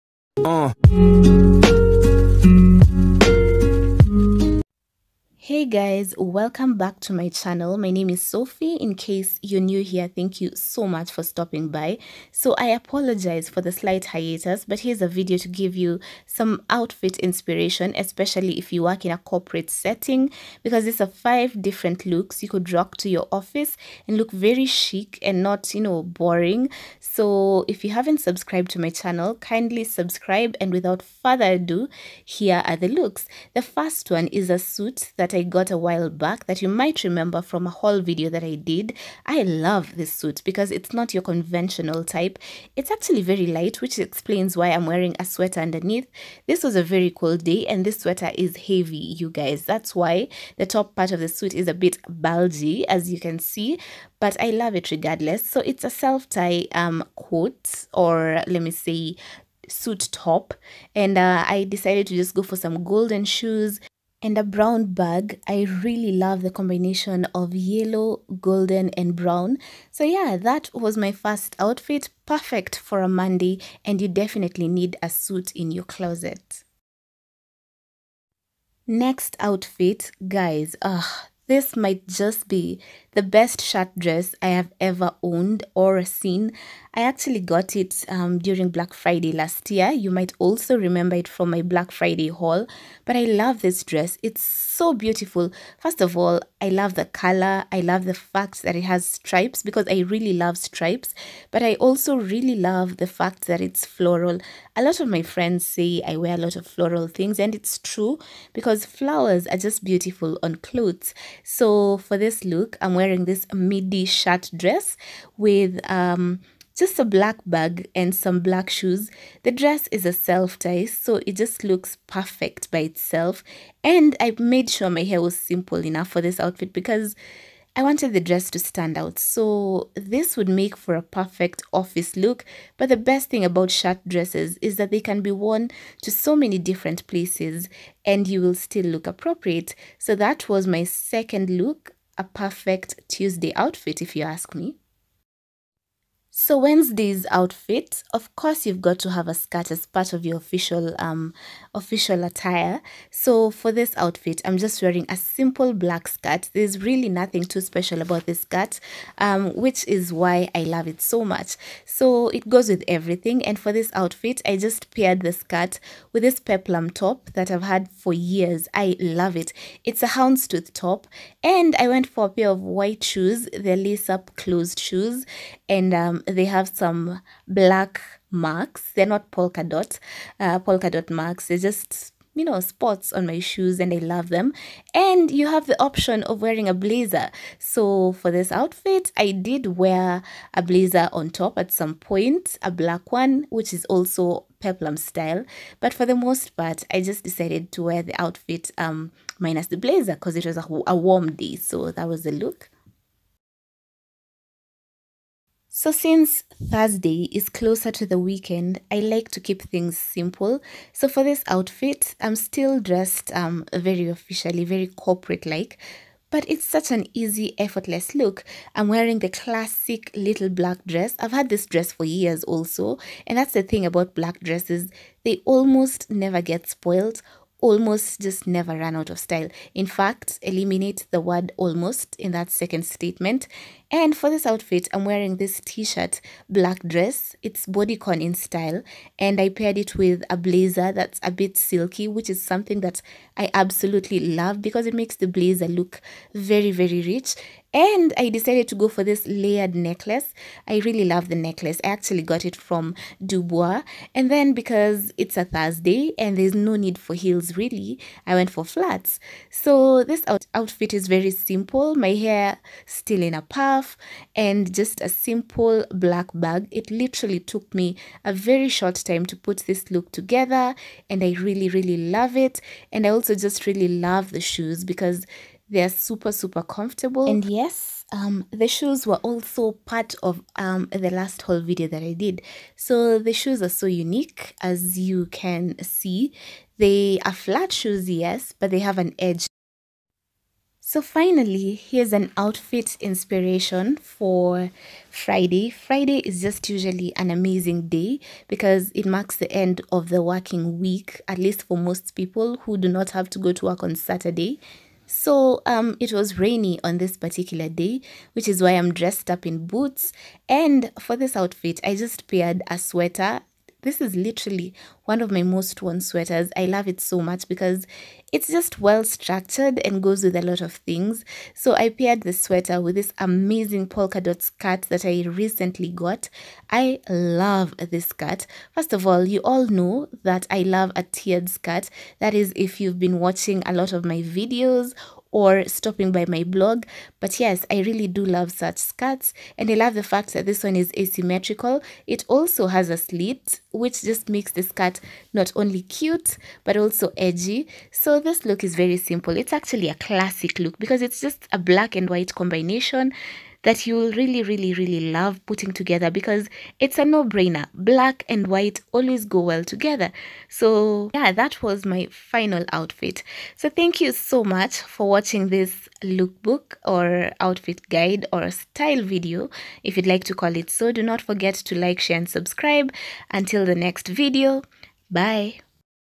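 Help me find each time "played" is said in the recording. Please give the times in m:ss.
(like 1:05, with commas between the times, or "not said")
not said.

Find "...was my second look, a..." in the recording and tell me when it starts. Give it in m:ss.
2:20.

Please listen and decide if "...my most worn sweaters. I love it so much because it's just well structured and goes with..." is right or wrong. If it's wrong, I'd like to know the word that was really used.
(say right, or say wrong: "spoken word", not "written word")
right.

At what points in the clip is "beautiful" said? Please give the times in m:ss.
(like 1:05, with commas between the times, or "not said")
1:34, 1:49.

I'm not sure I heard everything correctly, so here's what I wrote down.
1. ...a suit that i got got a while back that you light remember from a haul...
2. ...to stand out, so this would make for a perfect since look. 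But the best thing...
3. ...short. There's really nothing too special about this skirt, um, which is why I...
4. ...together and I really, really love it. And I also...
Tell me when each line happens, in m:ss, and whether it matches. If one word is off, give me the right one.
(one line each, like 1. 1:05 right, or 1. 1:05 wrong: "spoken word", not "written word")
1. 0:34 wrong: "might", not "light"
2. 2:08 wrong: "office", not "since"
3. 2:36 wrong: "skirt", not "short"
4. 4:30 right.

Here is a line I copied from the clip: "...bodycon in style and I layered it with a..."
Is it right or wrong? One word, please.
wrong.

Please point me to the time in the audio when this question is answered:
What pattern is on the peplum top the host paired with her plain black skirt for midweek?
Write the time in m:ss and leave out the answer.
2:50.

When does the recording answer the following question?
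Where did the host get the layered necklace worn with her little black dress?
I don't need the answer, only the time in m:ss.
4:13.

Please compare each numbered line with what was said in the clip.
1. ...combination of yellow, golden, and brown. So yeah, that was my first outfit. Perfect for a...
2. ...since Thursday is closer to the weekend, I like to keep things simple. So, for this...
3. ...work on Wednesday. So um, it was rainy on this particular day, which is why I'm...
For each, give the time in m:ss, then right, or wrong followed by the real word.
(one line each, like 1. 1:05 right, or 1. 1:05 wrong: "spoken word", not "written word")
1. 1:06 right
2. 3:25 right
3. 5:03 wrong: "Saturday", not "Wednesday".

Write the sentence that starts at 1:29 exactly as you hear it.
You might also remember it from my Black Friday haul.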